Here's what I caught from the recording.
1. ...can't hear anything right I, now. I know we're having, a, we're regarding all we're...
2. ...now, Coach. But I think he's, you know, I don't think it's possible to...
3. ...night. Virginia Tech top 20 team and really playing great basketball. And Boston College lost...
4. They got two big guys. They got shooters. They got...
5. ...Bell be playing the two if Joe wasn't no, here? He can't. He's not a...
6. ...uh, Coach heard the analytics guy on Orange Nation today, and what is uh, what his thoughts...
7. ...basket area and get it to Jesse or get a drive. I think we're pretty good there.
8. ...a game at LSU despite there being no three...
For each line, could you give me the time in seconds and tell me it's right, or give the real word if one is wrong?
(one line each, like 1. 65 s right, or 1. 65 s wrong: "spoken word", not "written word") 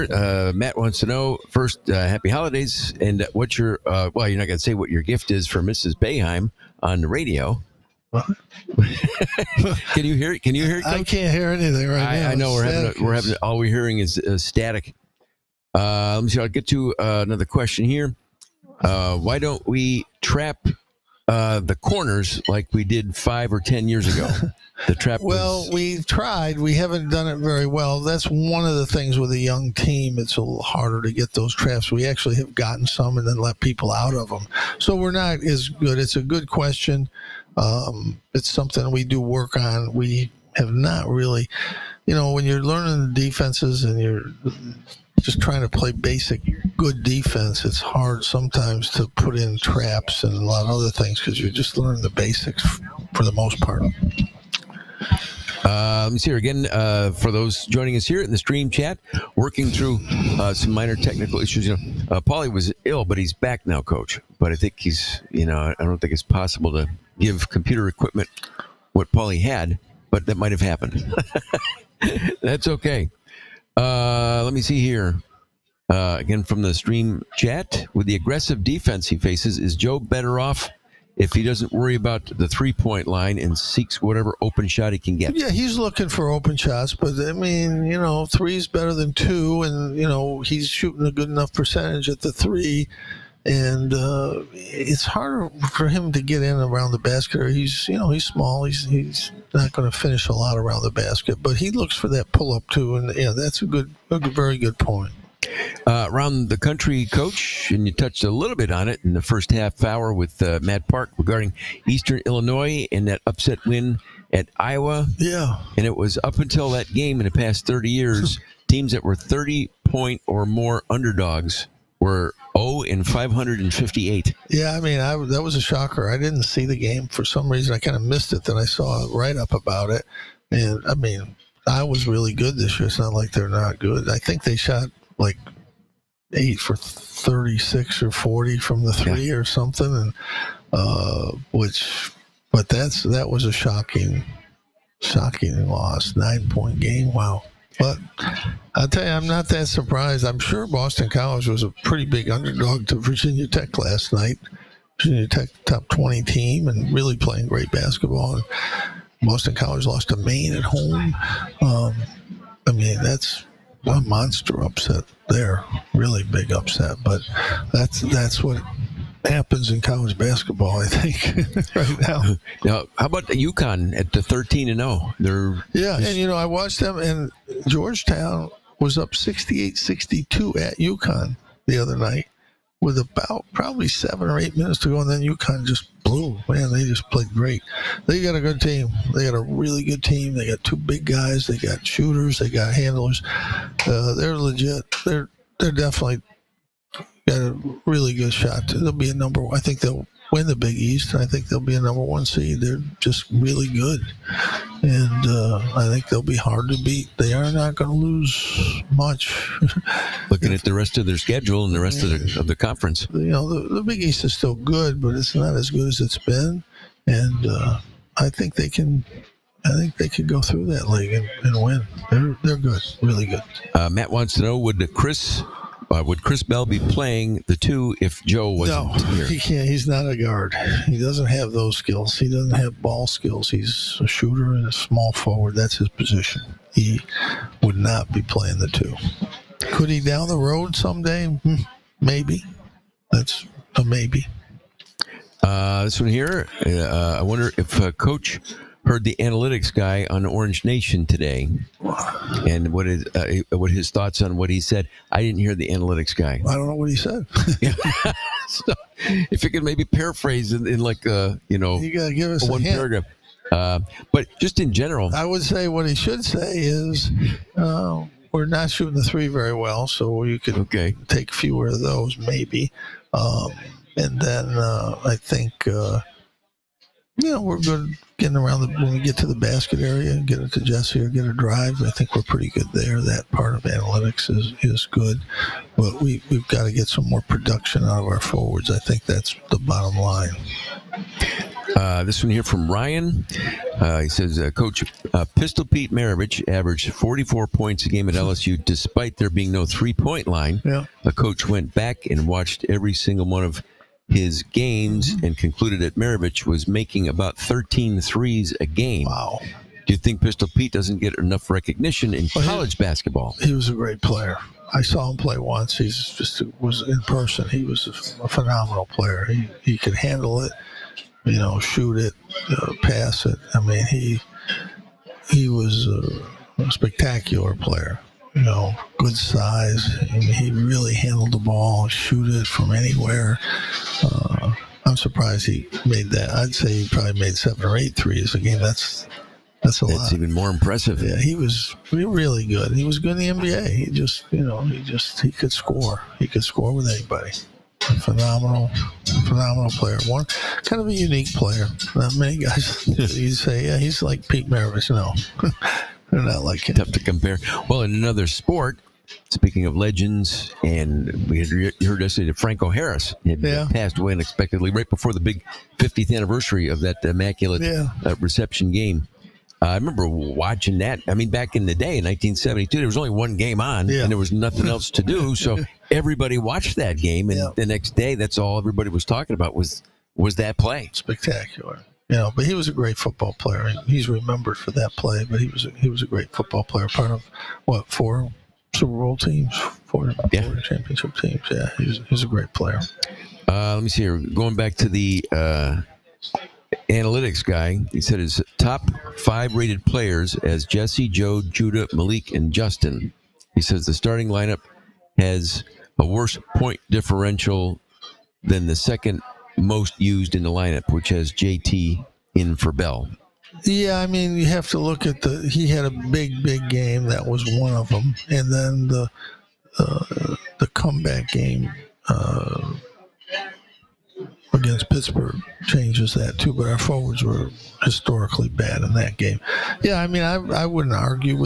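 1. 11 s wrong: "having", not "regarding"
2. 63 s right
3. 154 s right
4. 190 s right
5. 226 s right
6. 247 s right
7. 279 s right
8. 297 s right.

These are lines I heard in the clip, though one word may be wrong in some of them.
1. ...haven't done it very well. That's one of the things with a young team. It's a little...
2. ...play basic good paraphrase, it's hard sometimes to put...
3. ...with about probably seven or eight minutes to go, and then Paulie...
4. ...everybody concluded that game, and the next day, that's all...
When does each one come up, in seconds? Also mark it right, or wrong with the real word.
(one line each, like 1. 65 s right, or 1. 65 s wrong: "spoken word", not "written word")
1. 26 s right
2. 45 s wrong: "defense", not "paraphrase"
3. 182 s wrong: "UConn", not "Paulie"
4. 375 s wrong: "watched", not "concluded".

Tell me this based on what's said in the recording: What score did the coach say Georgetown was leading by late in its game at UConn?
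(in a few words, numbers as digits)
68-62.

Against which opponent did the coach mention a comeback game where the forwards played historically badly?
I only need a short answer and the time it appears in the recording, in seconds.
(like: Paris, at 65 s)
Pittsburgh, at 424 s.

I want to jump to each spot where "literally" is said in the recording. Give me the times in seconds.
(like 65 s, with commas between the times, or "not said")
not said.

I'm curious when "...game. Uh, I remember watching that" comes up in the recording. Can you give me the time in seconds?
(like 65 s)
368 s.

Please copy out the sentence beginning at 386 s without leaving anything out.
Part of what four Super Bowl teams, four, yeah.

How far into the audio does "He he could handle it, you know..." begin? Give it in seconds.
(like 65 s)
319 s.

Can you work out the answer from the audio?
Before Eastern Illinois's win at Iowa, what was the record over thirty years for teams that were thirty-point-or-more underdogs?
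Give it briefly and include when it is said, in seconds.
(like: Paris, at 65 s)
0 in 558, at 122 s.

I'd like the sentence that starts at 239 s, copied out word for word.
Could he down the road someday?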